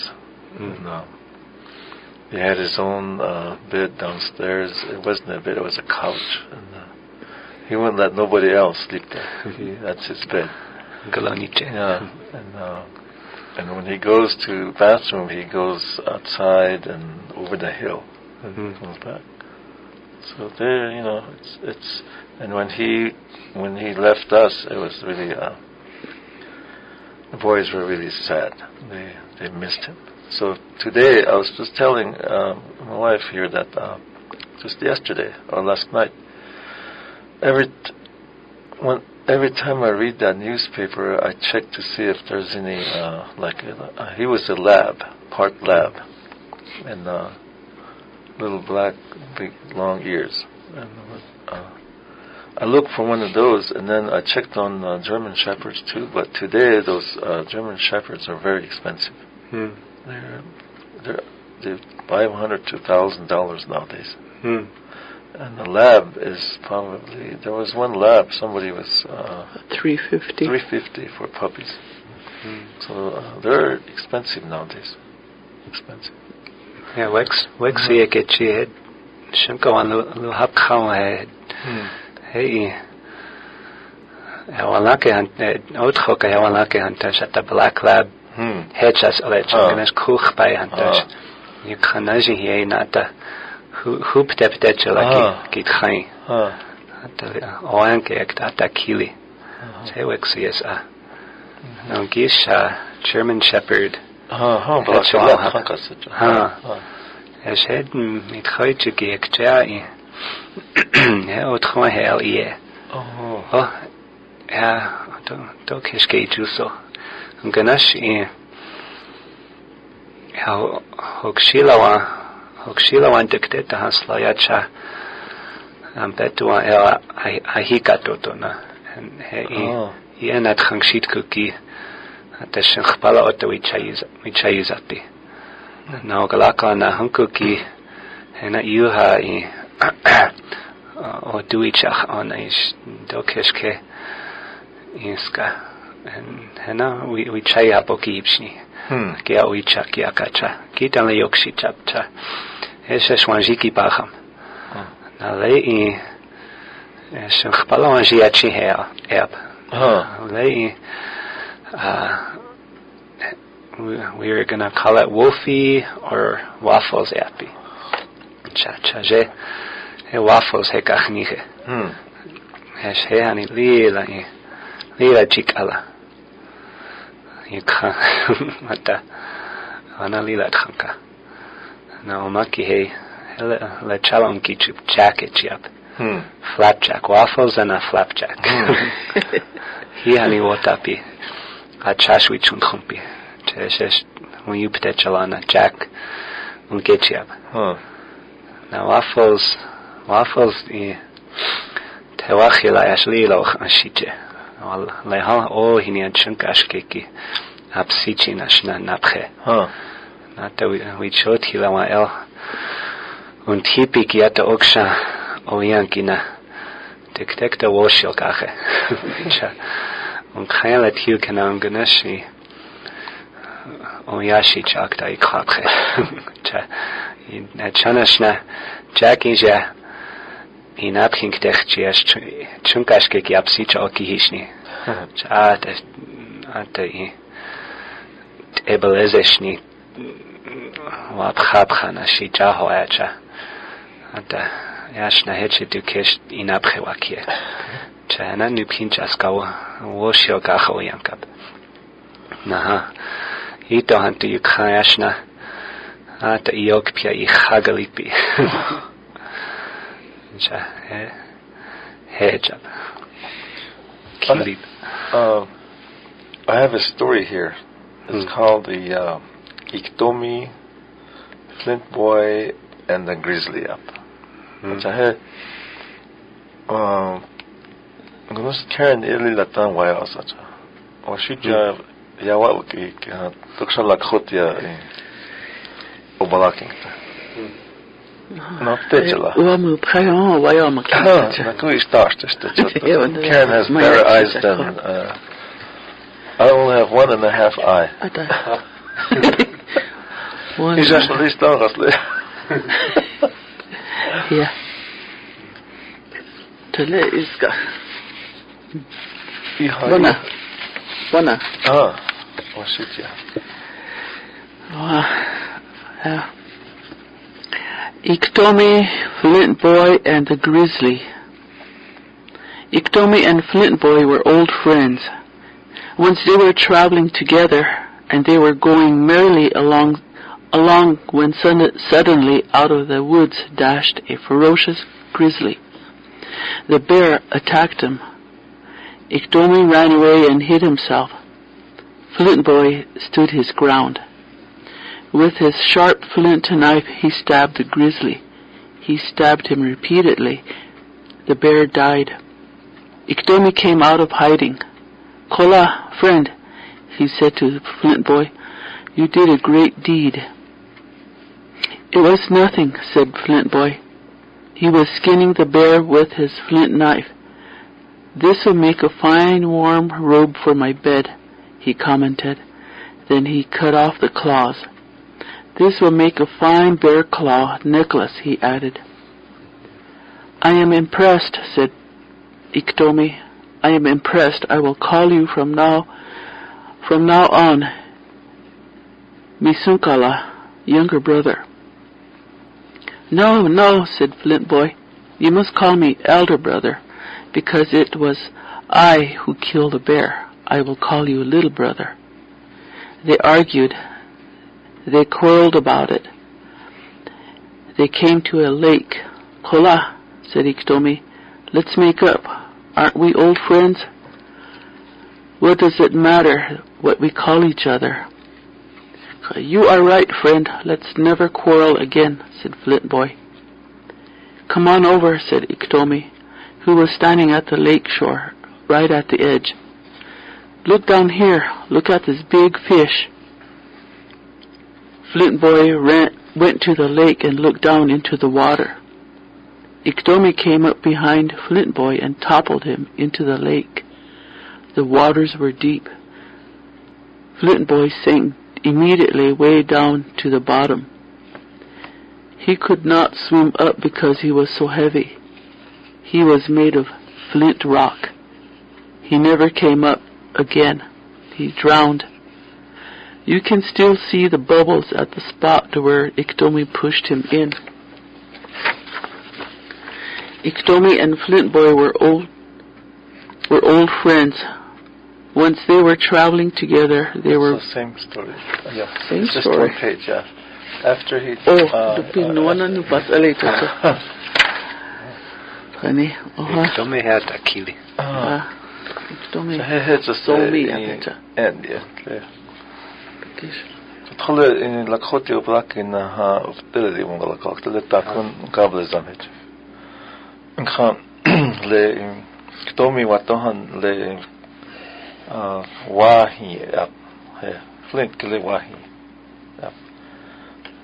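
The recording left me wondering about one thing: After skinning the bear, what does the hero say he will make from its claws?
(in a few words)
bear claw necklace.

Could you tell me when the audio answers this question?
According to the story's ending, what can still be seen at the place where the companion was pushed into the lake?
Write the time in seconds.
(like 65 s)
464 s.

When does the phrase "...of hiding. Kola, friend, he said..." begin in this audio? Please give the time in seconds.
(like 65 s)
353 s.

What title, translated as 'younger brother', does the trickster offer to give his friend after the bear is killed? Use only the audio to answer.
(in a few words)
Misunkala.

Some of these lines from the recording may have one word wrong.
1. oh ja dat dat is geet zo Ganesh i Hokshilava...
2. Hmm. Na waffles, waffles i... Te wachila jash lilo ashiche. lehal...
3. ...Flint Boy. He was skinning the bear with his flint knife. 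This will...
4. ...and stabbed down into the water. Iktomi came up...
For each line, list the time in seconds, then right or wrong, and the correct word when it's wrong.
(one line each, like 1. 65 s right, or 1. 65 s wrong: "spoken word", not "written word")
1. 113 s right
2. 197 s right
3. 363 s right
4. 437 s wrong: "looked", not "stabbed".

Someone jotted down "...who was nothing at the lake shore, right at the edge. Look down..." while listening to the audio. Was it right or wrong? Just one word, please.
wrong.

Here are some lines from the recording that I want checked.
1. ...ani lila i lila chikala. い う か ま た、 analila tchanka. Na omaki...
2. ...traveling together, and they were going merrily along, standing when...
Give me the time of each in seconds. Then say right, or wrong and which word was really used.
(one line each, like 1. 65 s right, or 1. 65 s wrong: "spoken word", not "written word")
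1. 173 s right
2. 326 s wrong: "along", not "standing".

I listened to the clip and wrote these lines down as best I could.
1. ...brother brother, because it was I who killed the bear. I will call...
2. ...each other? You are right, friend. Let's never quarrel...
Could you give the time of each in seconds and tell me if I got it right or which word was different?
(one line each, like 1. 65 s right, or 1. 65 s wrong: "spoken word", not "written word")
1. 396 s wrong: "elder", not "brother"
2. 417 s right.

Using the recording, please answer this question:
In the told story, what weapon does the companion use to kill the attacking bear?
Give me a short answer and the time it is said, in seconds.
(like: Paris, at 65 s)
sharp flint knife, at 345 s.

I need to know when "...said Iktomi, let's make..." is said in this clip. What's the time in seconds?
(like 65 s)
410 s.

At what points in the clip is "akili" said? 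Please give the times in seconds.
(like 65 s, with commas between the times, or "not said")
98 s, 487 s.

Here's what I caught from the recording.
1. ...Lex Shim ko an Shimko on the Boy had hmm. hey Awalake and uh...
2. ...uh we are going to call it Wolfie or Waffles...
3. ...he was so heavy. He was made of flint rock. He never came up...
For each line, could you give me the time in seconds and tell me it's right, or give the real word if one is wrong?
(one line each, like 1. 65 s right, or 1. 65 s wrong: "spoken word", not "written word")
1. 78 s wrong: "Hapkhala", not "Boy"
2. 161 s right
3. 454 s right.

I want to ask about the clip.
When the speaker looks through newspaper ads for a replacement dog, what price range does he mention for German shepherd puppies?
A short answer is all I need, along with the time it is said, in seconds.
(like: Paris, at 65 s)
$500 to $1,000, at 62 s.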